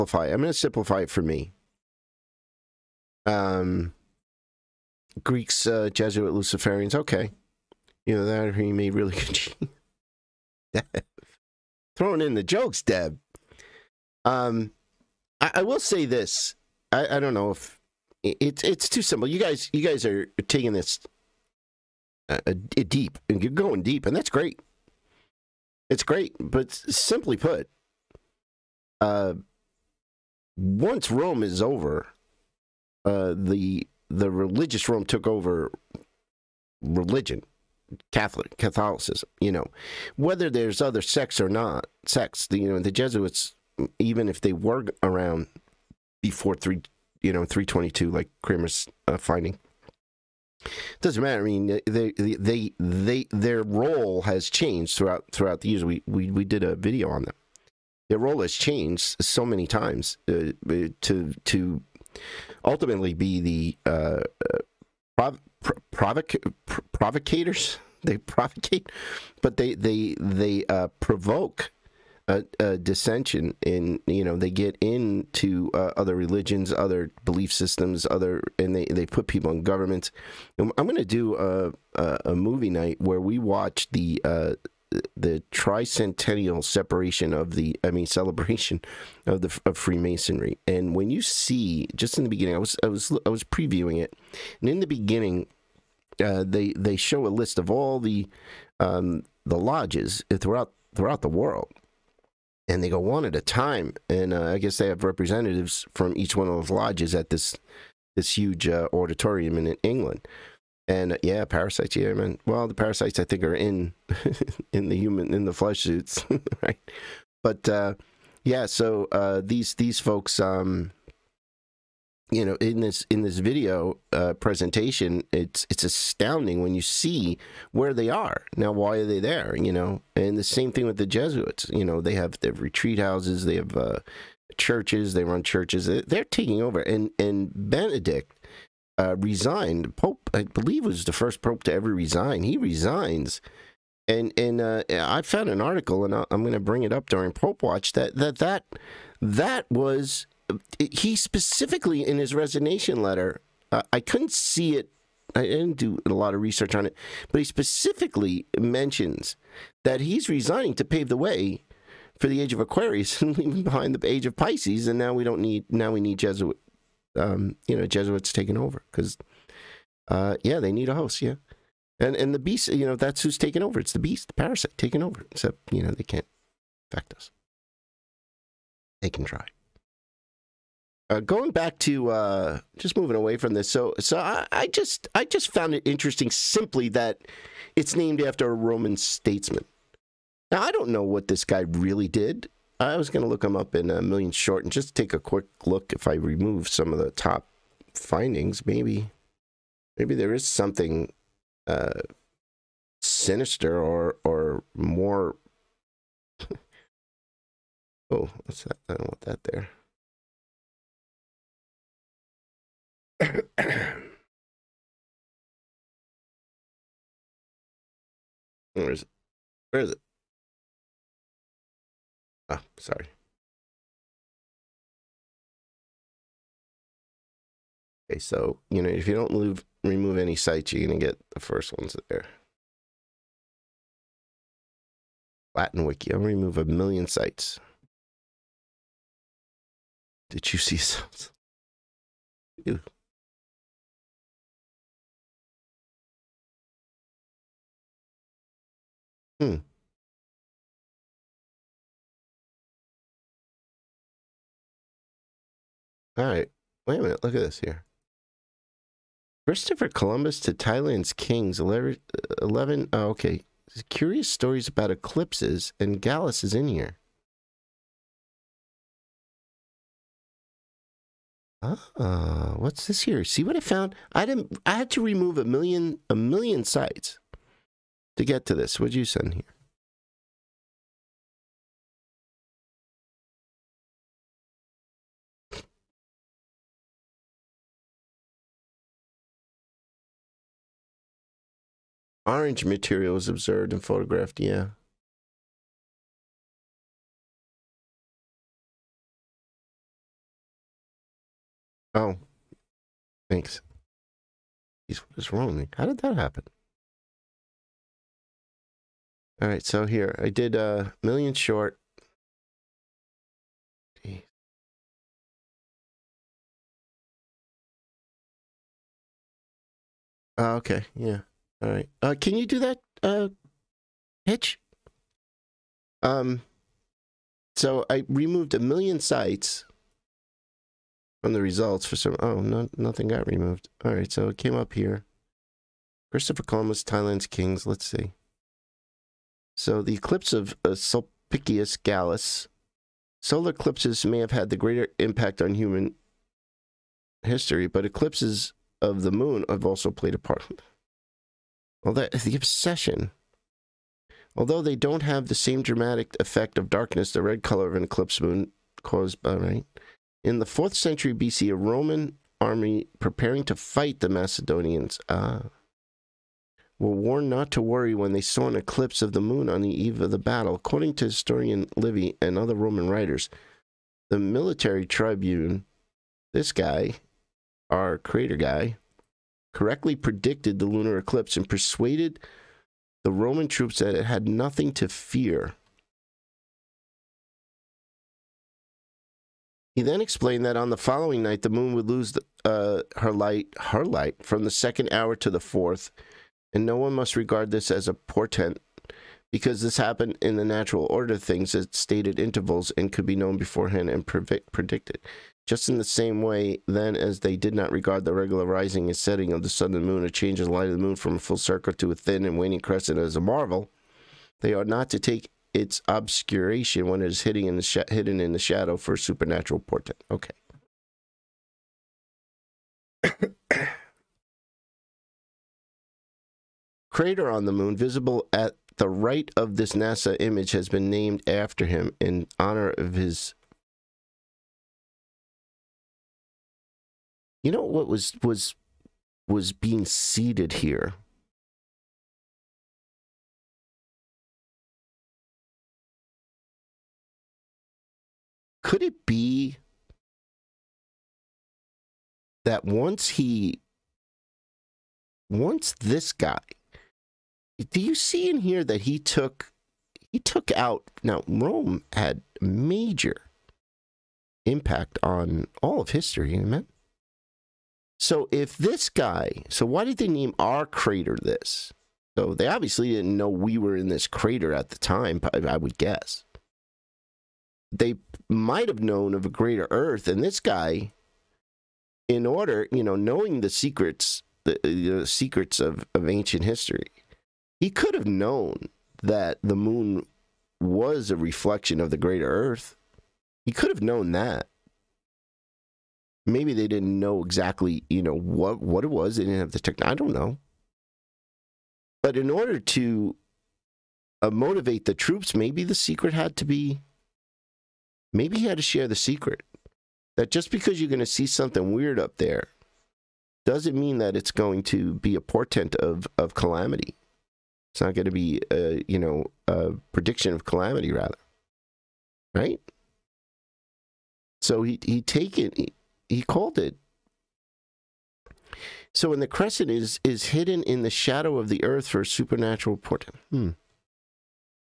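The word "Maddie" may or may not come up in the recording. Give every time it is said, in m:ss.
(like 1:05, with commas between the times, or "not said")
not said.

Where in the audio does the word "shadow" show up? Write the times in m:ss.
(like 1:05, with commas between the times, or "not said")
6:58, 8:50.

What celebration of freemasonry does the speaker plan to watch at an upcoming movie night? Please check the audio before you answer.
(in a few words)
Tricentennial.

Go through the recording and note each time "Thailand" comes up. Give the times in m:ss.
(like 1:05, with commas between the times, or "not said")
4:20, 5:36.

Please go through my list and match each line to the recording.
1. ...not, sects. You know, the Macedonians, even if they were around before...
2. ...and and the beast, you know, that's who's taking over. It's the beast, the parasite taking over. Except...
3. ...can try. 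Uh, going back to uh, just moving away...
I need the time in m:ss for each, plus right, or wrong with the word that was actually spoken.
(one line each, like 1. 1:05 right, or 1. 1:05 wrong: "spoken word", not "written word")
1. 0:41 wrong: "Jesuits", not "Macedonians"
2. 2:51 right
3. 2:59 right.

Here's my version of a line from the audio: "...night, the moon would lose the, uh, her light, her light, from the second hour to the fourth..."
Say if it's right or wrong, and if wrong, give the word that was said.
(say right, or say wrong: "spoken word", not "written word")
right.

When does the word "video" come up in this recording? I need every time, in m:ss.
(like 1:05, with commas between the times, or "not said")
0:56, 2:03.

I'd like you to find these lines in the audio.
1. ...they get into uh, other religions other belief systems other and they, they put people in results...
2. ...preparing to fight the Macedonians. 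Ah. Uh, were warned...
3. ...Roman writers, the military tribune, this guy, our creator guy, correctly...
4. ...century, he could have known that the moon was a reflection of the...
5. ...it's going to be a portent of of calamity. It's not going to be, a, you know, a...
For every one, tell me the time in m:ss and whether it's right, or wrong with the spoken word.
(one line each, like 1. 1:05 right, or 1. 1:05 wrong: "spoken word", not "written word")
1. 1:14 wrong: "governments", not "results"
2. 6:02 right
3. 6:12 right
4. 8:06 wrong: "history", not "century"
5. 8:34 right.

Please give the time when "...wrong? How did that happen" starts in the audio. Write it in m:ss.
5:05.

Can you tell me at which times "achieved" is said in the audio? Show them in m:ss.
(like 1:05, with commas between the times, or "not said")
not said.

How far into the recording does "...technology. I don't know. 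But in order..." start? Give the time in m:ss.
8:19.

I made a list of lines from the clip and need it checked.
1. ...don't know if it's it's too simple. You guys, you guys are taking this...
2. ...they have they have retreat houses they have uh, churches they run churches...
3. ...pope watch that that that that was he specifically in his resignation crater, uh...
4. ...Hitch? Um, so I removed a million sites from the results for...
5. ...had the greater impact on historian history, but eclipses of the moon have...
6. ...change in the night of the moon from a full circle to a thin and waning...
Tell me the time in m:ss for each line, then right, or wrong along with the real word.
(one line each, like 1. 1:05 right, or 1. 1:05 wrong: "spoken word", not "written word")
1. 0:17 right
2. 2:12 right
3. 2:27 wrong: "letter", not "crater"
4. 5:24 right
5. 5:44 wrong: "human", not "historian"
6. 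6:50 wrong: "light", not "night".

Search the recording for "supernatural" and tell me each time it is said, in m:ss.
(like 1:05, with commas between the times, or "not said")
6:58, 8:52.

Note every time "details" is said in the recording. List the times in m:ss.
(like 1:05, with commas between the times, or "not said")
not said.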